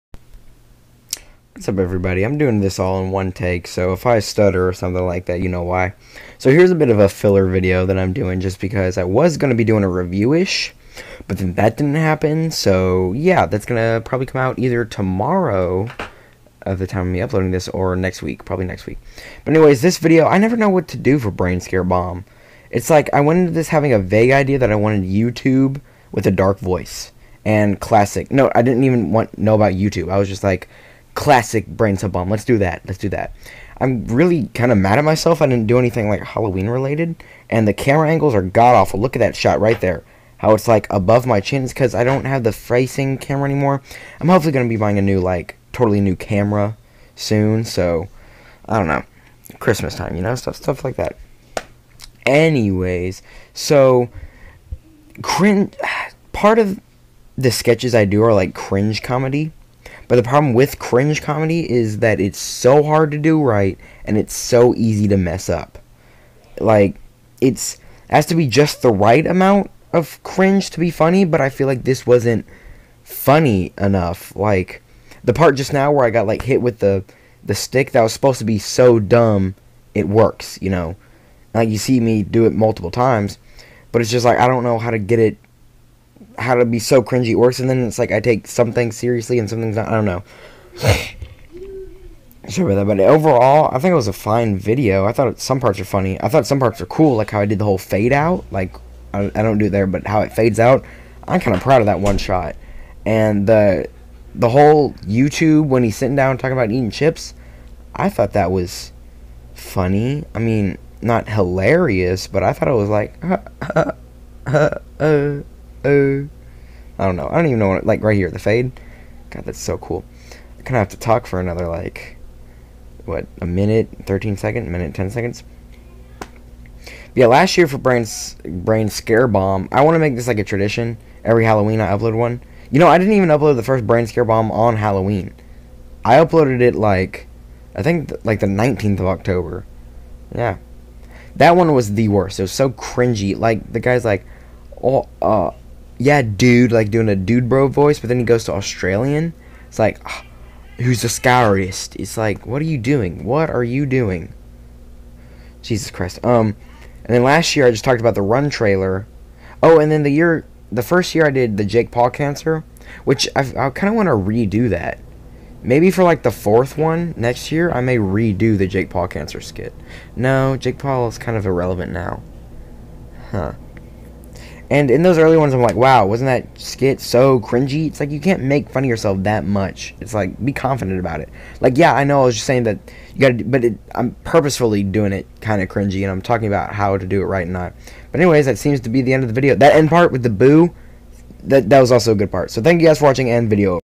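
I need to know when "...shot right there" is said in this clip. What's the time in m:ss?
0:39.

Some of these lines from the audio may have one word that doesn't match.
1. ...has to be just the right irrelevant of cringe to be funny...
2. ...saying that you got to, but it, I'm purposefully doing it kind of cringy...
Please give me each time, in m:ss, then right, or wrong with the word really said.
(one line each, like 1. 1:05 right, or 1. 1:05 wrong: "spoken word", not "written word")
1. 1:08 wrong: "amount", not "irrelevant"
2. 3:02 right.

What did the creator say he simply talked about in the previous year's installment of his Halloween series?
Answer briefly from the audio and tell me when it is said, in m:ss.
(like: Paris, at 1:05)
The Run trailer, at 2:38.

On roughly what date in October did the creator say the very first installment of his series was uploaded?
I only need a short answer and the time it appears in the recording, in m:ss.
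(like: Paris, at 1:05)
19th of October, at 2:18.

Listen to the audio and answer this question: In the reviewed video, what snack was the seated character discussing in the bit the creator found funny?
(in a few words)
chips.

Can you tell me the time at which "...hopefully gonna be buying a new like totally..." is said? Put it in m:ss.
0:44.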